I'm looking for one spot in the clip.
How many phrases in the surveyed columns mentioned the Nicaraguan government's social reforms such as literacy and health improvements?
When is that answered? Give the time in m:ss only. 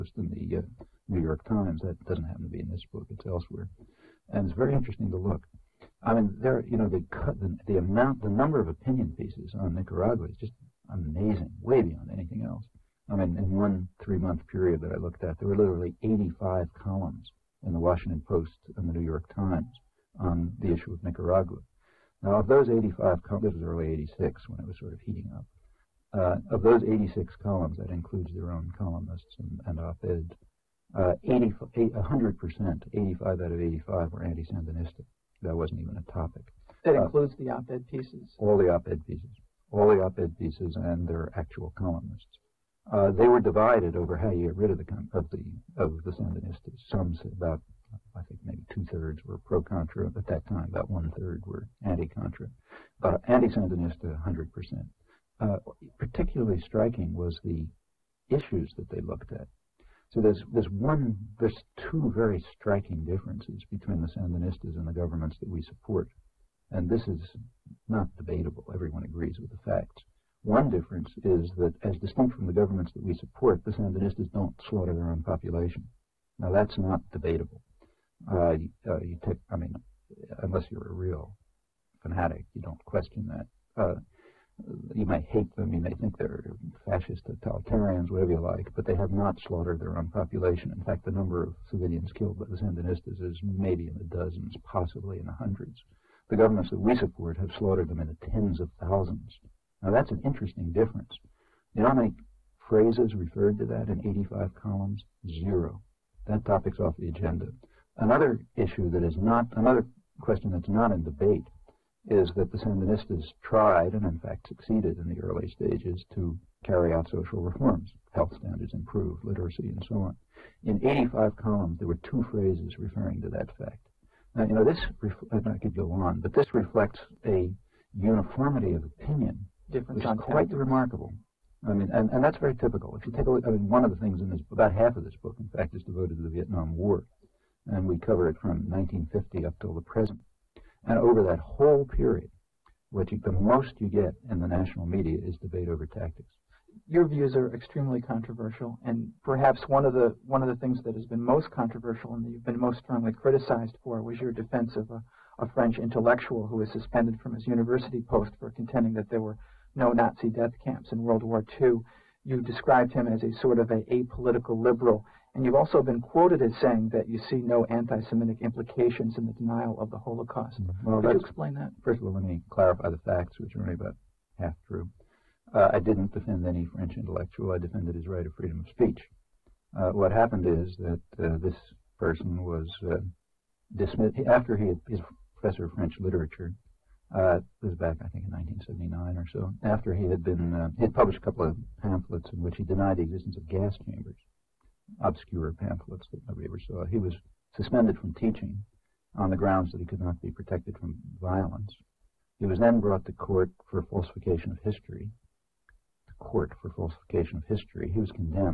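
2:02.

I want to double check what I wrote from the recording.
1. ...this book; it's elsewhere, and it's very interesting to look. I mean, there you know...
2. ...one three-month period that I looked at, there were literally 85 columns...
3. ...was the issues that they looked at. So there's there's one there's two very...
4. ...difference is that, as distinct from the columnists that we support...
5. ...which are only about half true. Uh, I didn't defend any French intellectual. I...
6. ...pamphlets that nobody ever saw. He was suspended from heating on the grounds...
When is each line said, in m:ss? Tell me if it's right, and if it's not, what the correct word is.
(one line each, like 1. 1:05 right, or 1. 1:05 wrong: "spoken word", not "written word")
1. 0:02 right
2. 0:13 right
3. 0:57 right
4. 1:10 wrong: "governments", not "columnists"
5. 2:53 right
6. 3:15 wrong: "teaching", not "heating".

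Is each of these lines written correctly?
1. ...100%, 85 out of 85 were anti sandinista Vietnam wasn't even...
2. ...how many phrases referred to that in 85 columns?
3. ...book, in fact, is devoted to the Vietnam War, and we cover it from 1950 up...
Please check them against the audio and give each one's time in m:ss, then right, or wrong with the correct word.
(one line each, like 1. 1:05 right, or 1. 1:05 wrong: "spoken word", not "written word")
1. 0:31 wrong: "That", not "Vietnam"
2. 1:41 right
3. 2:15 right.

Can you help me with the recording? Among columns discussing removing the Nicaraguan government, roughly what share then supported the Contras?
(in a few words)
two thirds.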